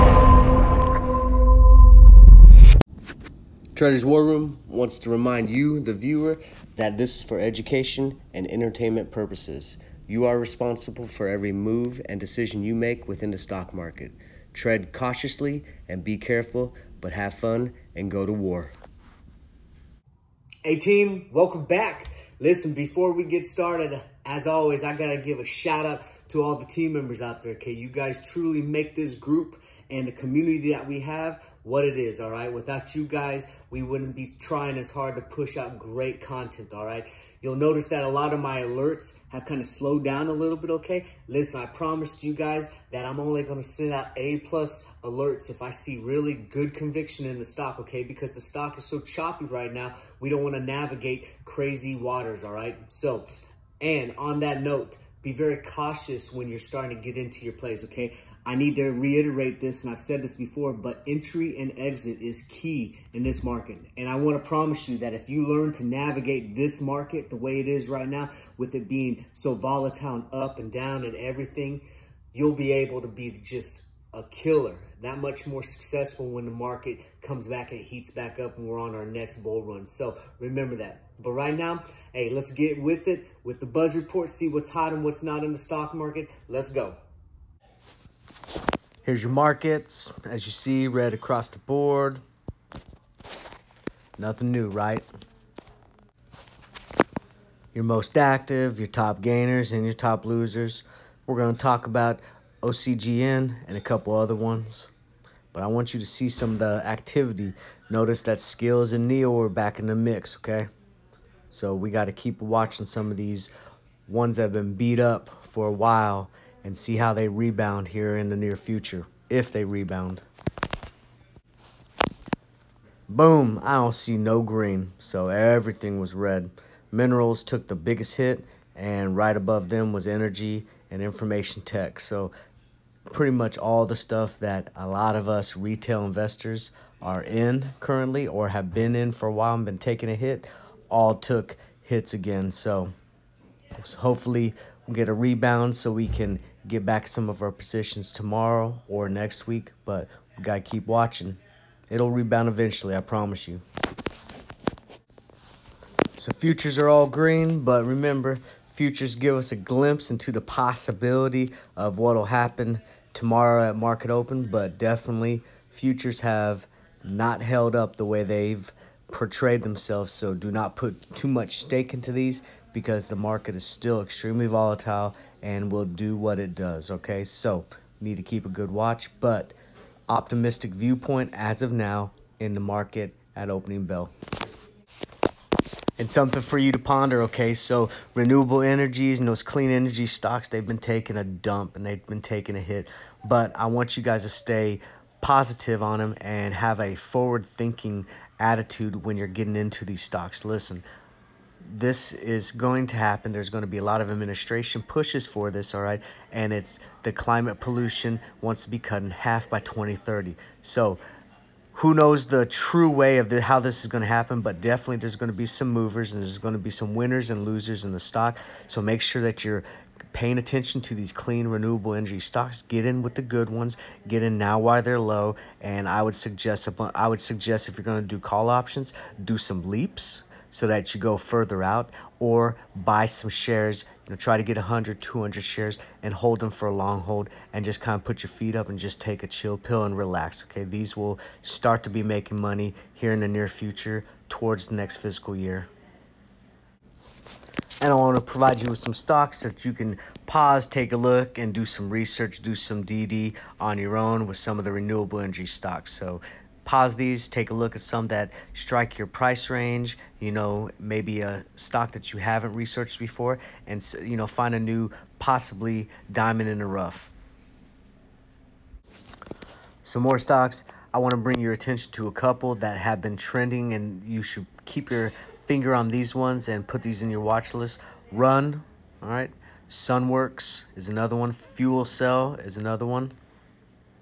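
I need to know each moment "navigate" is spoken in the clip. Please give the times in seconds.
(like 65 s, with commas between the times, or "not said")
50 s, 65 s.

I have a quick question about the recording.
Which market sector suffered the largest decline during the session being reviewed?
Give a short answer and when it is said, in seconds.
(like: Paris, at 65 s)
Minerals, at 126 s.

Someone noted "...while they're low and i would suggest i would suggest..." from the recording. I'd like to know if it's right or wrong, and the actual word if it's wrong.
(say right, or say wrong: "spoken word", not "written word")
right.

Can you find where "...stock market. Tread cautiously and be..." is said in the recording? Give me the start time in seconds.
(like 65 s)
13 s.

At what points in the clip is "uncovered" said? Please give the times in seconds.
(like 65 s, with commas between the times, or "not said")
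not said.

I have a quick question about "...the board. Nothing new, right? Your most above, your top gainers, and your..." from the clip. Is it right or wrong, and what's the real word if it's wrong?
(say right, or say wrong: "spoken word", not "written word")
wrong: "active", not "above".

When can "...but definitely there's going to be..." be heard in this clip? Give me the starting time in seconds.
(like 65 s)
214 s.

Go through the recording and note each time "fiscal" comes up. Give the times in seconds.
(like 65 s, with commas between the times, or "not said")
244 s.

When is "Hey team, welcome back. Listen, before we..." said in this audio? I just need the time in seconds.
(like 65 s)
20 s.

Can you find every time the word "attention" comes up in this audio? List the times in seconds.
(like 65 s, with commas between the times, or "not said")
220 s, 271 s.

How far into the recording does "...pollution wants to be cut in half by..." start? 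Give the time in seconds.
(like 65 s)
207 s.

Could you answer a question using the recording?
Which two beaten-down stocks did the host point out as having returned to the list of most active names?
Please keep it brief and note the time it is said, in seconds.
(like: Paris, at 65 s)
Skillz and NIO, at 108 s.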